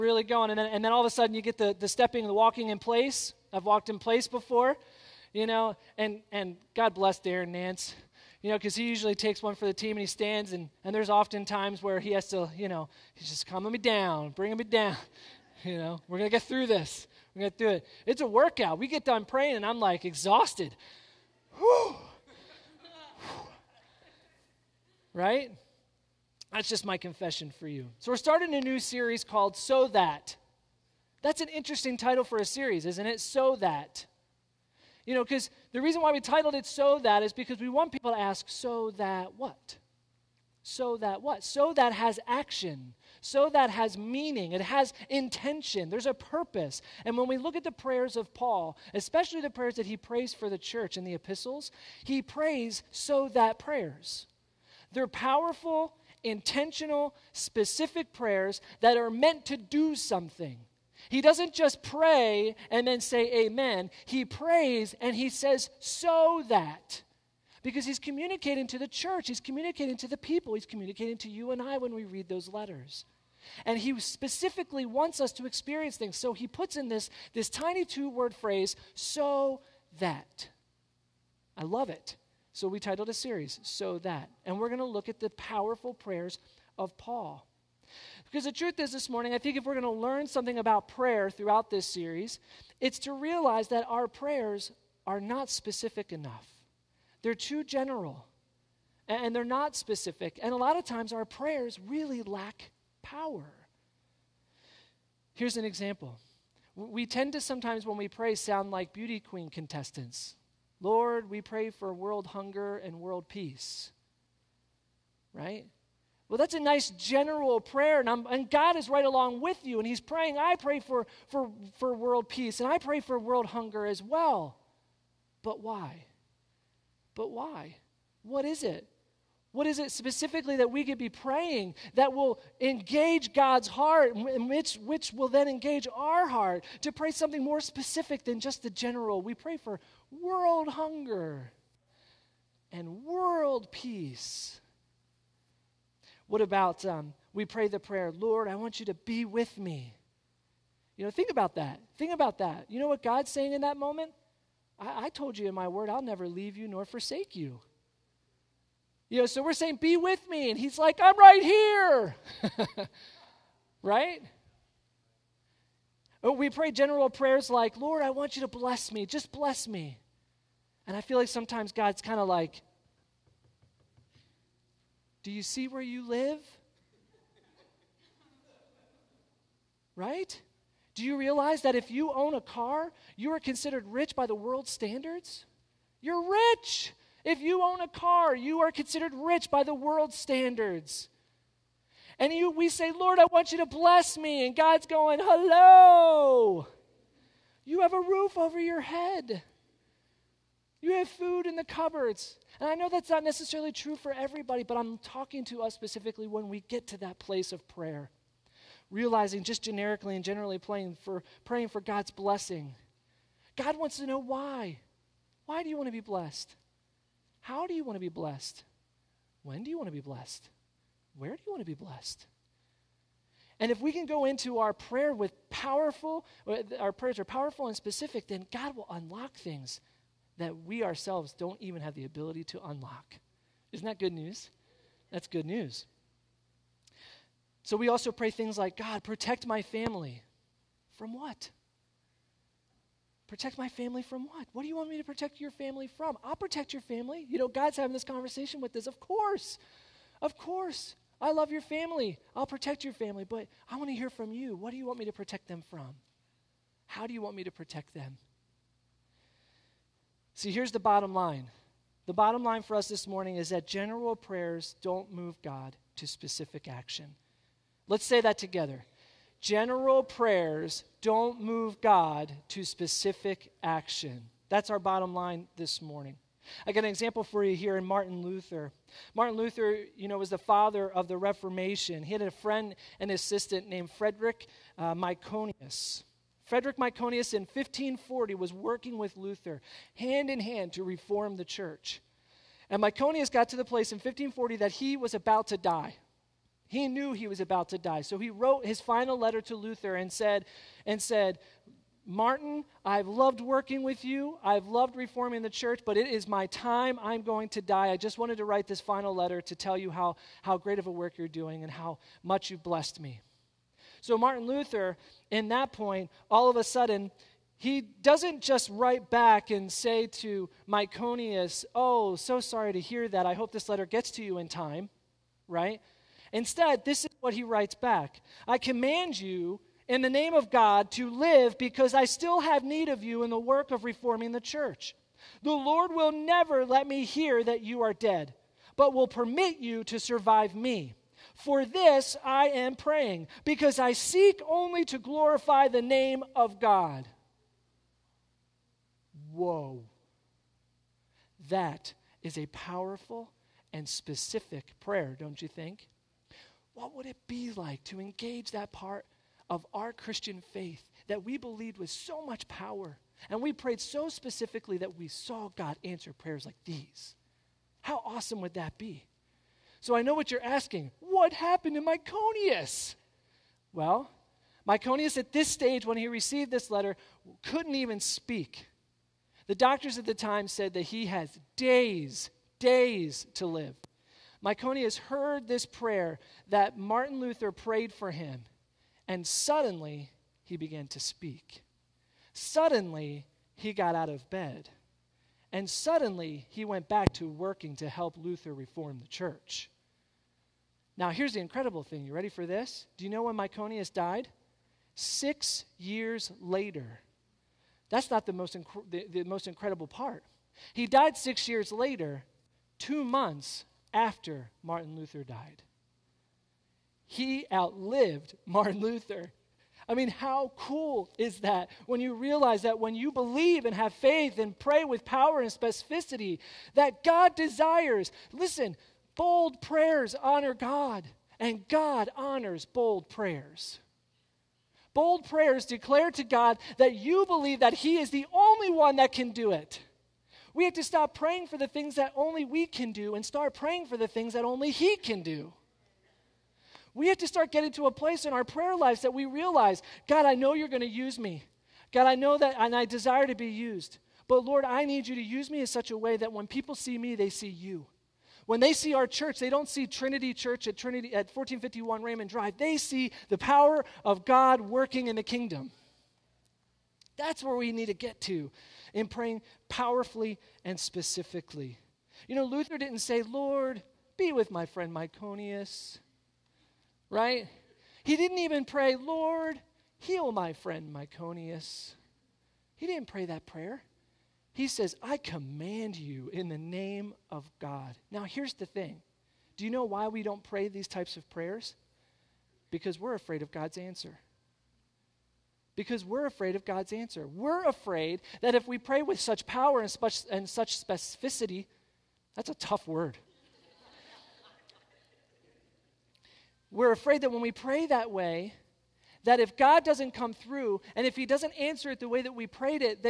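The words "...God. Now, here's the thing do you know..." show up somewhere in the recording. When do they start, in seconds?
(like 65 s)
487 s.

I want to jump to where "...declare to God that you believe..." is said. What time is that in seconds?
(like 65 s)
435 s.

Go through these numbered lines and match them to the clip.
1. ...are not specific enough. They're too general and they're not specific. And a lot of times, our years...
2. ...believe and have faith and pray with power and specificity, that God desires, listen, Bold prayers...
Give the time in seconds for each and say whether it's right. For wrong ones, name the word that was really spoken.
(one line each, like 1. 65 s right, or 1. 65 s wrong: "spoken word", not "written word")
1. 95 s wrong: "prayers", not "years"
2. 423 s right.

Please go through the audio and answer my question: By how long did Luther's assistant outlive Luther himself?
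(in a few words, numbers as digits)
2 months.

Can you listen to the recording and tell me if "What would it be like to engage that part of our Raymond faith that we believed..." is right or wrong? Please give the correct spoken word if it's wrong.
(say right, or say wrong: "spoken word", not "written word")
wrong: "Christian", not "Raymond".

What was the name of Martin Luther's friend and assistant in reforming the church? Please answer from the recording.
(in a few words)
Frederick Myconius.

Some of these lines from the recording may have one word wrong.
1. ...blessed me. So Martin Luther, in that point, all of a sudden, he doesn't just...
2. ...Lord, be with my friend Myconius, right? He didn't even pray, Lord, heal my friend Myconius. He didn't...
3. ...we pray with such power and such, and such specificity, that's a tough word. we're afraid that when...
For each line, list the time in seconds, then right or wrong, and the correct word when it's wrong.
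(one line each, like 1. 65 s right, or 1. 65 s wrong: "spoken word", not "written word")
1. 312 s right
2. 473 s right
3. 498 s right.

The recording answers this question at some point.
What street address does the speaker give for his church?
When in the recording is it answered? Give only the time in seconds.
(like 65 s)
461 s.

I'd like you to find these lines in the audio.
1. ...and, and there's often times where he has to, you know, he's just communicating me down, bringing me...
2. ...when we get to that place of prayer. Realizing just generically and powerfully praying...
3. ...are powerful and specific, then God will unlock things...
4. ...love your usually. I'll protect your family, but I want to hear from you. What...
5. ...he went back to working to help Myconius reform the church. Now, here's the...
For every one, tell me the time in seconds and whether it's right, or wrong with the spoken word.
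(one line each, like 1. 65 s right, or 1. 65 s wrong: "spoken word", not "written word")
1. 10 s wrong: "calming", not "communicating"
2. 206 s wrong: "generally", not "powerfully"
3. 227 s right
4. 251 s wrong: "family", not "usually"
5. 396 s wrong: "Luther", not "Myconius".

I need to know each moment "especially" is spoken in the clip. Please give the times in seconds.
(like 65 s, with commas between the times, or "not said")
48 s.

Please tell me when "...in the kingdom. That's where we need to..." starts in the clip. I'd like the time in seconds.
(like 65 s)
465 s.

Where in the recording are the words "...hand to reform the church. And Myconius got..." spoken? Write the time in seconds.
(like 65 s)
290 s.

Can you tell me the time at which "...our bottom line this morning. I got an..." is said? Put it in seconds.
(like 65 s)
274 s.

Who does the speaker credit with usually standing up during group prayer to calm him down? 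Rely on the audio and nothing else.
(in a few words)
Darren Nance.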